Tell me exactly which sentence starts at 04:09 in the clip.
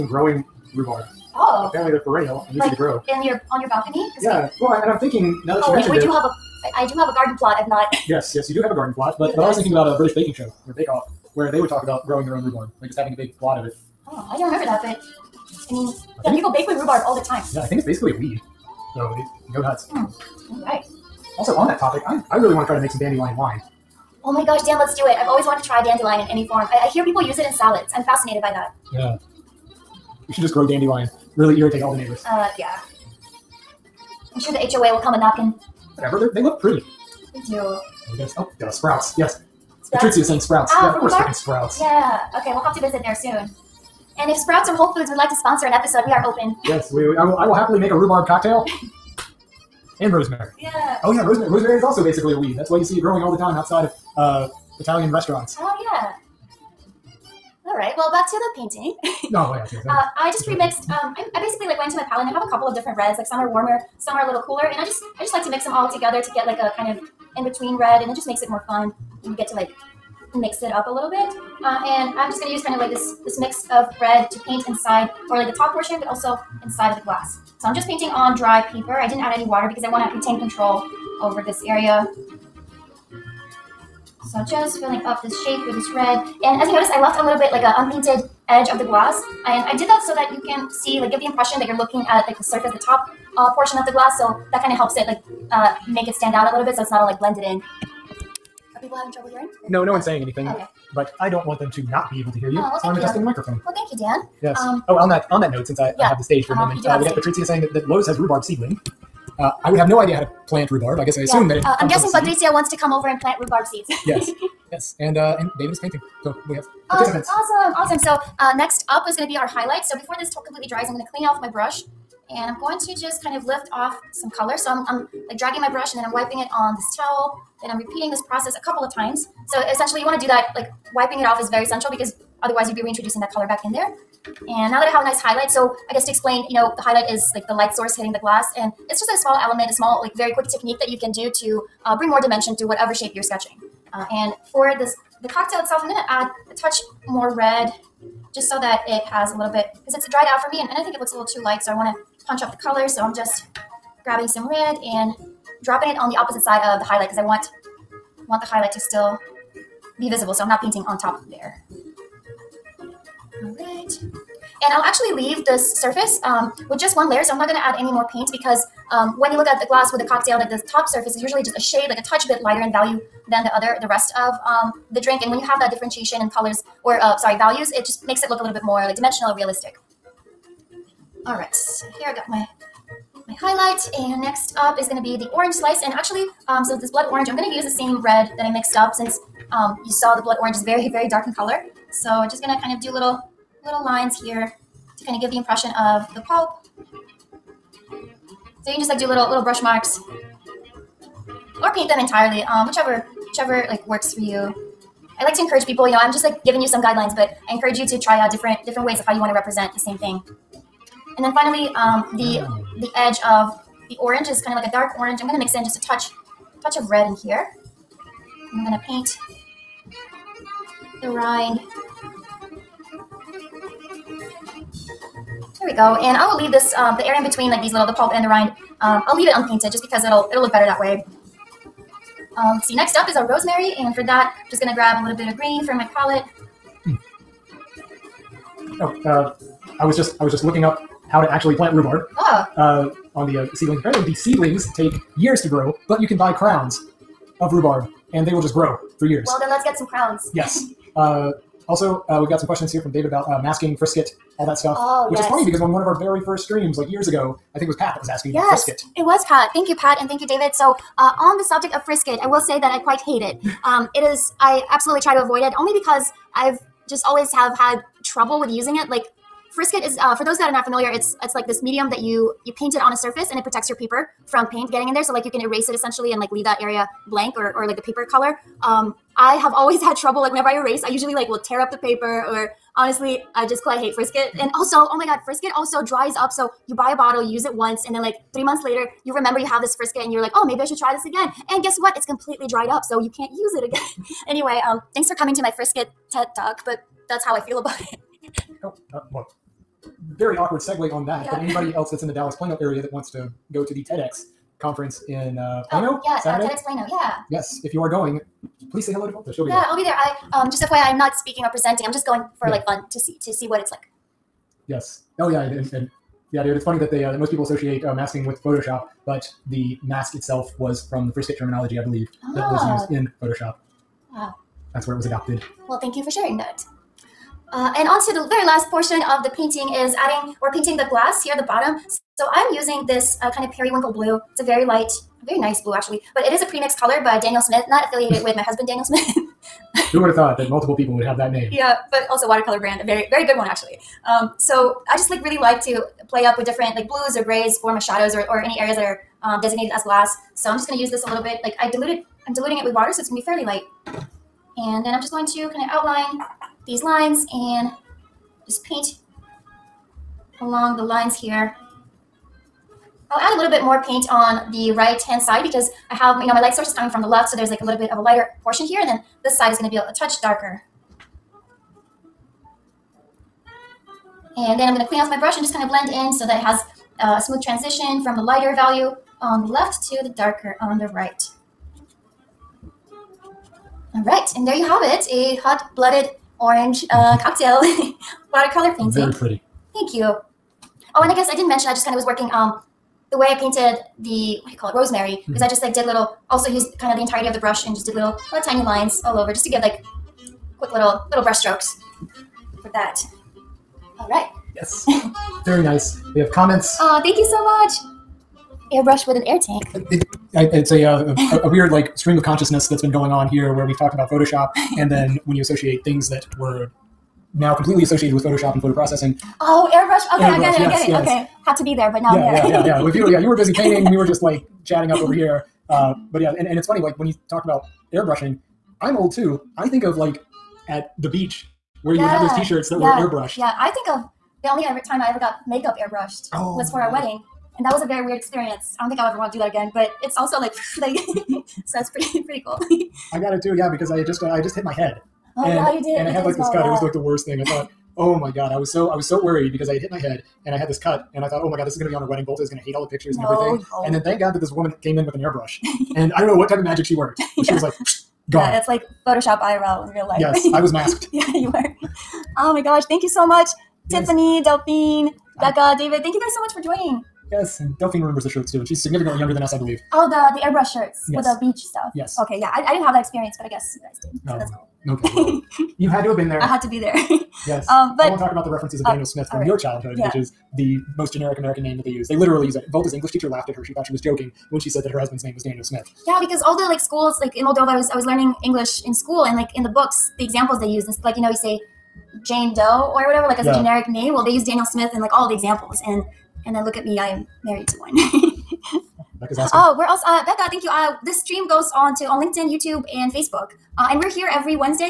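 Well, then let's get some crowns.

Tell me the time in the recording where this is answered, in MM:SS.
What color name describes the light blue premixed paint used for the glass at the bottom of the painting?
05:33.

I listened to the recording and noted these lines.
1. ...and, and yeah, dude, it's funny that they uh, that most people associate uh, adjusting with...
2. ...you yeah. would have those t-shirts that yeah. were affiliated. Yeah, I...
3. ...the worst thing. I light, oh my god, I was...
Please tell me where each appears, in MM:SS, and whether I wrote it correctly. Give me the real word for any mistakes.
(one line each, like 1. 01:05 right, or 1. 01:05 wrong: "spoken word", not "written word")
1. 05:15 wrong: "masking", not "adjusting"
2. 07:11 wrong: "airbrushed", not "affiliated"
3. 07:26 wrong: "thought", not "light".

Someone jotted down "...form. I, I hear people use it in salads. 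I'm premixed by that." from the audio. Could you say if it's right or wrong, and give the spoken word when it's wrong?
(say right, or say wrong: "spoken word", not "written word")
wrong: "fascinated", not "premixed".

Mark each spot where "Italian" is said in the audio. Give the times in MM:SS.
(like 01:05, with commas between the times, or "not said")
00:54.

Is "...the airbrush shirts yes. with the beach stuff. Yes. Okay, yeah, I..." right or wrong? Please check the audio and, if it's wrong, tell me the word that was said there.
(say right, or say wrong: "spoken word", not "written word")
right.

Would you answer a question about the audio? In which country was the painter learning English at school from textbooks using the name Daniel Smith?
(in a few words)
Moldova.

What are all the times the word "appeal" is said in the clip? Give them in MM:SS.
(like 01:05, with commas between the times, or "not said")
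not said.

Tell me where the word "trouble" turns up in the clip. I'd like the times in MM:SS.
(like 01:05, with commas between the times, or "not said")
01:39, 04:28, 04:39.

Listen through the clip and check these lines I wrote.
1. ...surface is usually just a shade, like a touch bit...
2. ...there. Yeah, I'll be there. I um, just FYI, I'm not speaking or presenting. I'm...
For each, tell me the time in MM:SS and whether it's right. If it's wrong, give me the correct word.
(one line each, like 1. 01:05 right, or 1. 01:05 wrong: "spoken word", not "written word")
1. 02:50 right
2. 05:09 right.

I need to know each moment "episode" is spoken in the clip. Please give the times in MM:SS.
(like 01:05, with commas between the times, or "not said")
00:45.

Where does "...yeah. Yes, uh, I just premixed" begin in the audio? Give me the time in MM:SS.
00:59.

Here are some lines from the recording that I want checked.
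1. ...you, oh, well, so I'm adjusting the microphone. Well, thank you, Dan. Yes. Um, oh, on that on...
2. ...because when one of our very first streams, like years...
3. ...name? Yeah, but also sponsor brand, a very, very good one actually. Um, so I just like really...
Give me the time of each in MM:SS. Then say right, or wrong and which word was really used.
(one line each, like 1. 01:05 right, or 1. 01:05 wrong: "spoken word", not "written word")
1. 01:42 right
2. 04:15 right
3. 05:41 wrong: "watercolor", not "sponsor".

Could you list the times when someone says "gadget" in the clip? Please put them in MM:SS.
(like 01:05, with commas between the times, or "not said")
not said.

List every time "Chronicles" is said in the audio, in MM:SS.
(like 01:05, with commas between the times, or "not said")
not said.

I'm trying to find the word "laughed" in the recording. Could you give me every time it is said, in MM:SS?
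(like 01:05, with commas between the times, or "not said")
08:03.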